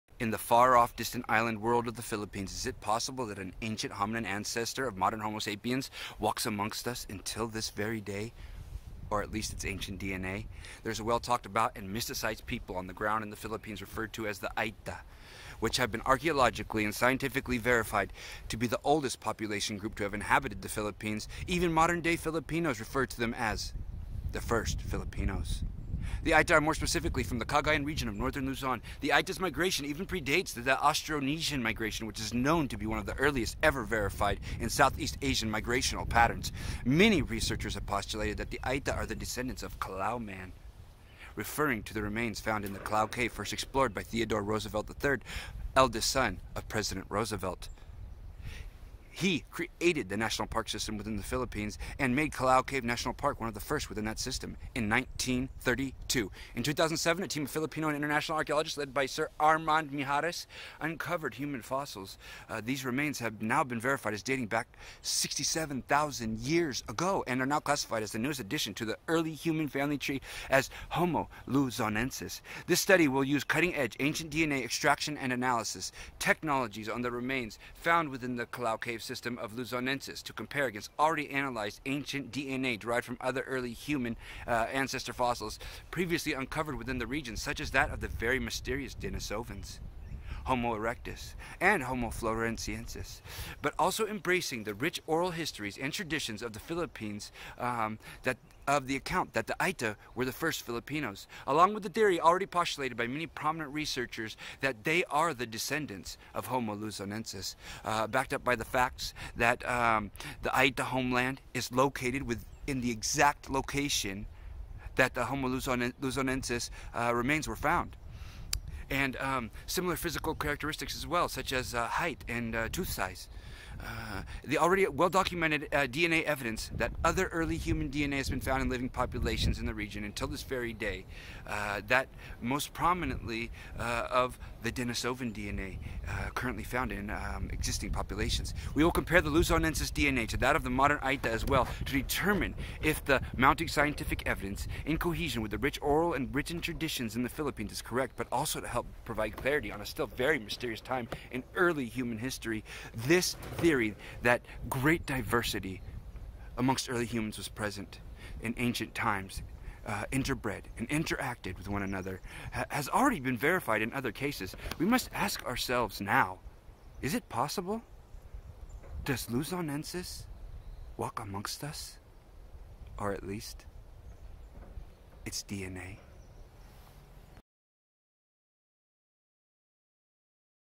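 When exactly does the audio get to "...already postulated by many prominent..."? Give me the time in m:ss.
1:42.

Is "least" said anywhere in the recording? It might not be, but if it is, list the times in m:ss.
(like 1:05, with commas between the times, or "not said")
0:09, 2:53.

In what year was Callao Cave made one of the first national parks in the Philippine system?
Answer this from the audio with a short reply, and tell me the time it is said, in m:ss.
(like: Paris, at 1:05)
1932, at 0:54.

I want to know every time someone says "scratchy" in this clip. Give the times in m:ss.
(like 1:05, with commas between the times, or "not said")
not said.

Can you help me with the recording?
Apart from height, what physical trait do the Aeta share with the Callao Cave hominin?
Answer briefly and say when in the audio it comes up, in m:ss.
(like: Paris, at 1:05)
tooth size, at 2:02.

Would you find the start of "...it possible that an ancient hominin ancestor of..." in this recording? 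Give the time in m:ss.
0:02.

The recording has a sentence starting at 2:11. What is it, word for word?
Uh, that most prominently uh, of the Denisovan DNA uh, currently found in um, existing populations.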